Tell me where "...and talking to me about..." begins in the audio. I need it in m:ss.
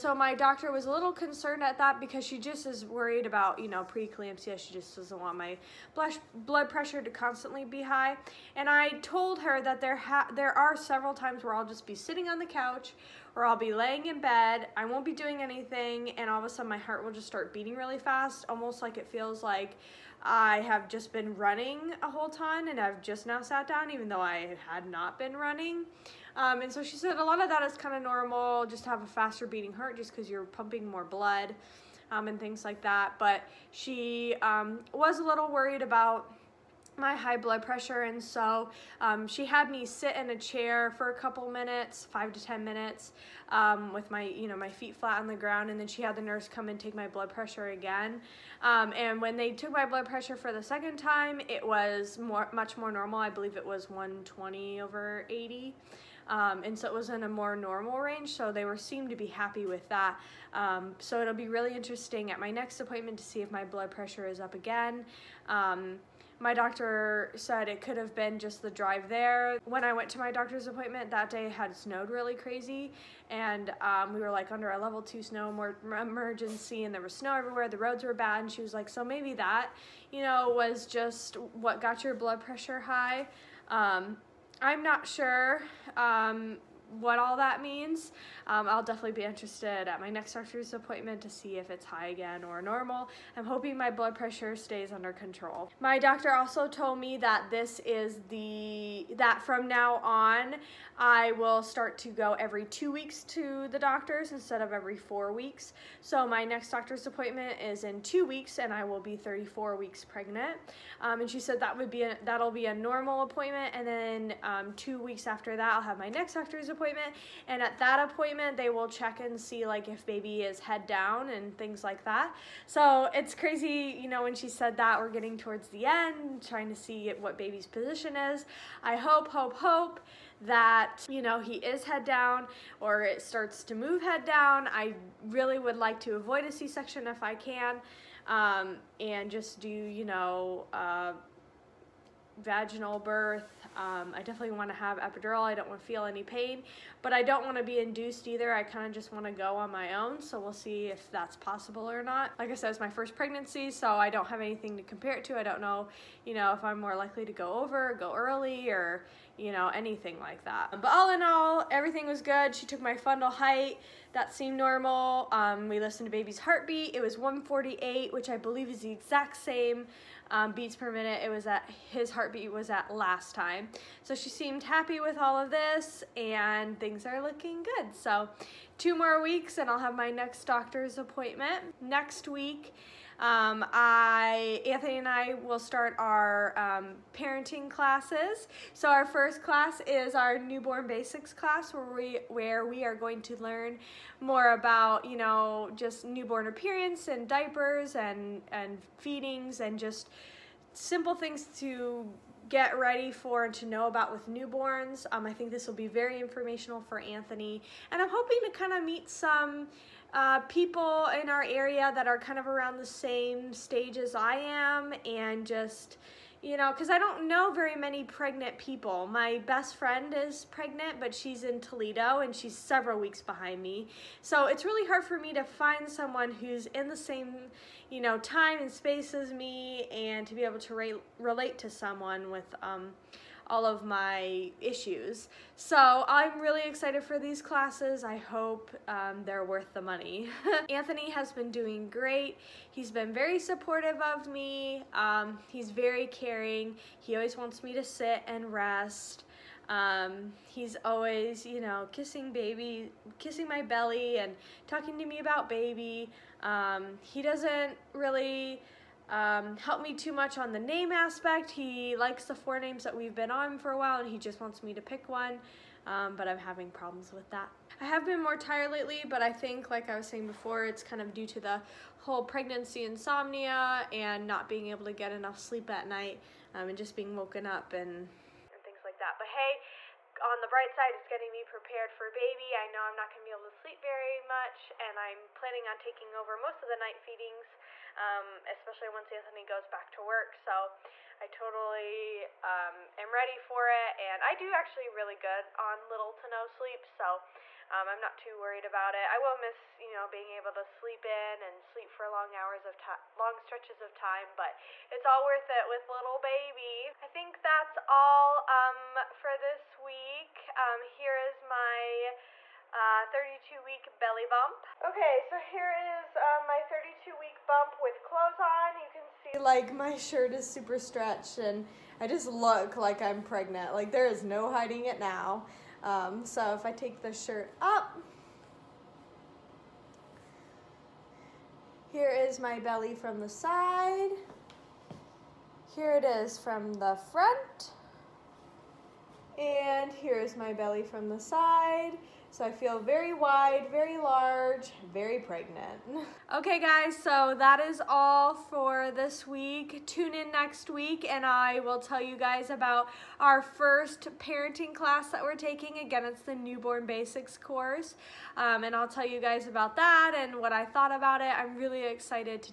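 4:14.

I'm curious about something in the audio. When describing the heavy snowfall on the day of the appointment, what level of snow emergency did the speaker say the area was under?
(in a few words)
Level 2.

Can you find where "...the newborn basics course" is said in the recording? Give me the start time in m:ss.
5:56.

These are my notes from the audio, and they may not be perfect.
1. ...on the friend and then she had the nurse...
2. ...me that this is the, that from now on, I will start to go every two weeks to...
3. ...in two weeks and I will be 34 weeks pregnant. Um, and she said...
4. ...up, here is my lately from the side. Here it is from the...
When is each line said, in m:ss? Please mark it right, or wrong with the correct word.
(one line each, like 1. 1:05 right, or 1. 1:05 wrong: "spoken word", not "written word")
1. 0:45 wrong: "ground", not "friend"
2. 1:36 right
3. 1:47 right
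4. 5:27 wrong: "belly", not "lately".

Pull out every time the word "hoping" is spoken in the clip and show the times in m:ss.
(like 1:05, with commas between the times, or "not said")
1:33, 3:28.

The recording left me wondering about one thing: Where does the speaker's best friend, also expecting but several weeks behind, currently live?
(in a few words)
Toledo.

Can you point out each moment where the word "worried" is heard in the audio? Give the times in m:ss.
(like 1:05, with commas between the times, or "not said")
0:02, 0:35, 4:58.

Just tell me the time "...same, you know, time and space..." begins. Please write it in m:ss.
3:46.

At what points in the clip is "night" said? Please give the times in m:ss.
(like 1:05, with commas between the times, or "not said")
4:35, 4:46.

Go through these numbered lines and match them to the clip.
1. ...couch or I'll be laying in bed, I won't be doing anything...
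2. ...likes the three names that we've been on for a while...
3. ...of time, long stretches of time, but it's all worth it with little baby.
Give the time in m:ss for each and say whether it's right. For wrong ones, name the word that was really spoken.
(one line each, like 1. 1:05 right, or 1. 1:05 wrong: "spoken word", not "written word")
1. 0:12 right
2. 4:21 wrong: "four", not "three"
3. 5:02 right.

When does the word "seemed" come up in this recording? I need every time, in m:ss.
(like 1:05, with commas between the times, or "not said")
0:58, 2:44, 2:54.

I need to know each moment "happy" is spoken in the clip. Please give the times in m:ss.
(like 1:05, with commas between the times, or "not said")
0:59, 2:54.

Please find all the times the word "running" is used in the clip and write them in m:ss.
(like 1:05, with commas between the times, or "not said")
0:21, 0:25.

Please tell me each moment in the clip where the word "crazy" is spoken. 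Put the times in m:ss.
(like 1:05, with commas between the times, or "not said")
1:12, 2:03.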